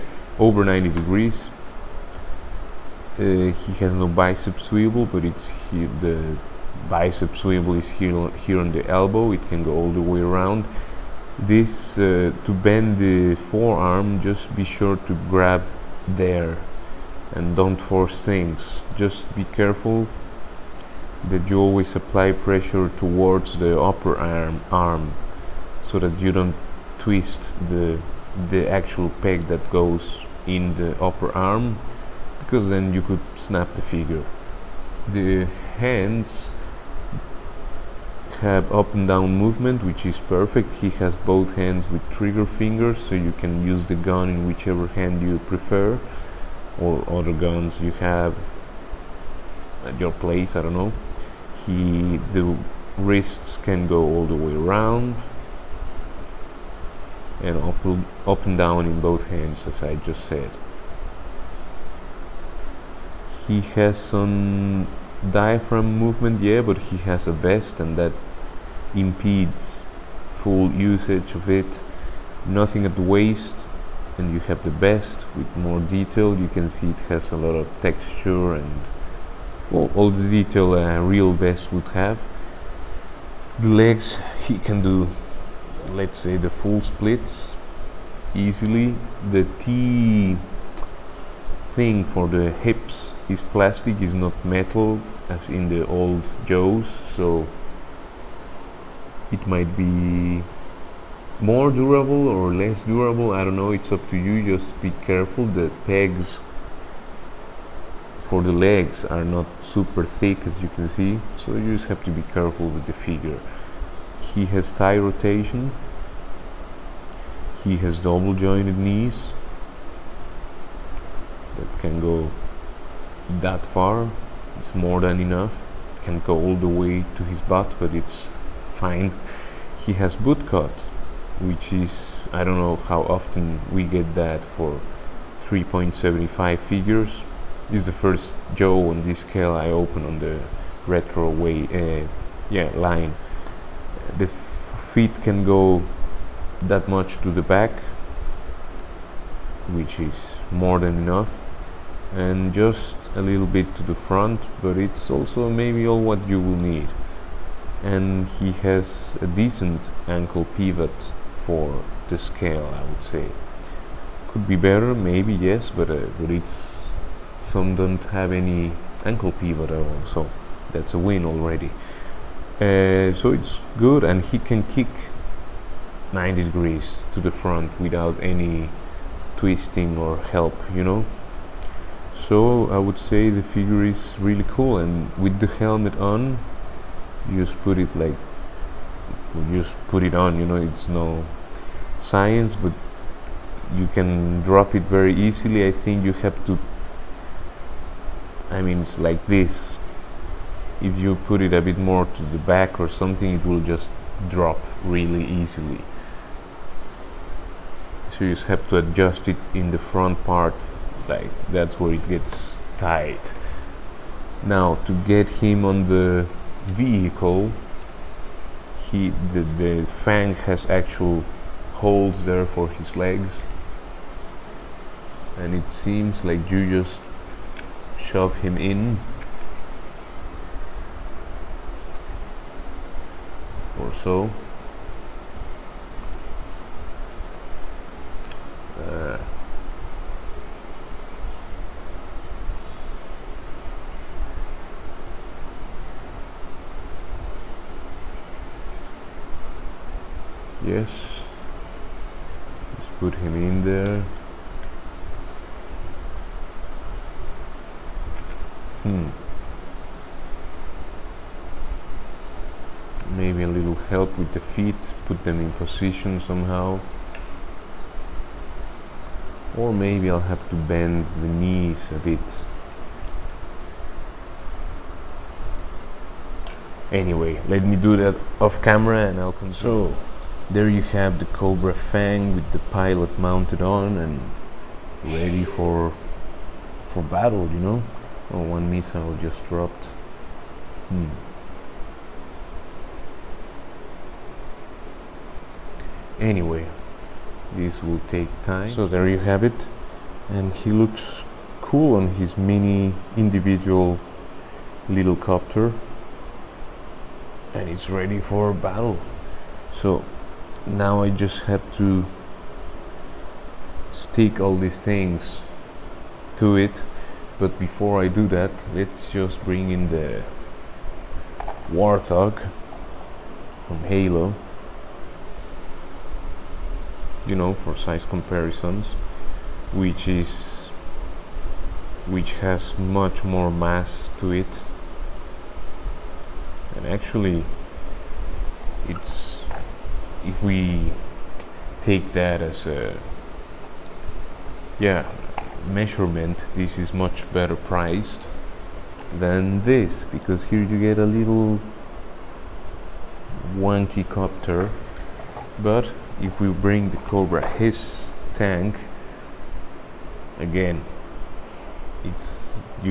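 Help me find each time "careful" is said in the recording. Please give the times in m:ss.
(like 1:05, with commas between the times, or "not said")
0:19, 1:45, 1:52.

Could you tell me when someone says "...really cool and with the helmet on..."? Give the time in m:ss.
3:04.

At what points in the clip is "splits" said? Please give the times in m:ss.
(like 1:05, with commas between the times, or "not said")
1:26.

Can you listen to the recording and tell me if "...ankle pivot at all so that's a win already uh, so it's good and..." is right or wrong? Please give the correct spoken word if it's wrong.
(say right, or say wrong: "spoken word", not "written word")
right.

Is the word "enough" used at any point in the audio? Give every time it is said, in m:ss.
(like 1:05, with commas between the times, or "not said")
2:05, 2:30.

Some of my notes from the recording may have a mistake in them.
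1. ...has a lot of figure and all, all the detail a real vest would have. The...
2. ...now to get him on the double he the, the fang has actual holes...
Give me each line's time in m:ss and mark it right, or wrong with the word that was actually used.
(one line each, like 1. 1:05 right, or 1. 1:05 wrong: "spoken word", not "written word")
1. 1:17 wrong: "texture", not "figure"
2. 3:34 wrong: "vehicle", not "double".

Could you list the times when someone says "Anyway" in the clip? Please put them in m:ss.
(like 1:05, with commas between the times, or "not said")
4:36, 4:56.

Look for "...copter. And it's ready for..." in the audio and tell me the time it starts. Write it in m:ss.
5:05.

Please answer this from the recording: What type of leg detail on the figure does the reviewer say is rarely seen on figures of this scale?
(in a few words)
Boot cut.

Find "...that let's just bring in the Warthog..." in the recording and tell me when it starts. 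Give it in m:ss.
5:18.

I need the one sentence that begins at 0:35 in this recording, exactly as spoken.
The hands have up and down movement which is perfect.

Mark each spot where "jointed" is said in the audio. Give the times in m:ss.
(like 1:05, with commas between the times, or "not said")
1:58.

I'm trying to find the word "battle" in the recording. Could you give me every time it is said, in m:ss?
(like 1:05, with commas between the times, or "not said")
4:47, 5:08.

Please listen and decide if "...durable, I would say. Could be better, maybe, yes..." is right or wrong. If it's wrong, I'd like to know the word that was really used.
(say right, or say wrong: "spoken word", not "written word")
wrong: "scale", not "durable".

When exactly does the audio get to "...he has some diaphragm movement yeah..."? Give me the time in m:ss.
1:03.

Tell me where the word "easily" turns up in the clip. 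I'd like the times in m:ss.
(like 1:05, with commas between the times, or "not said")
1:28, 3:15, 3:25.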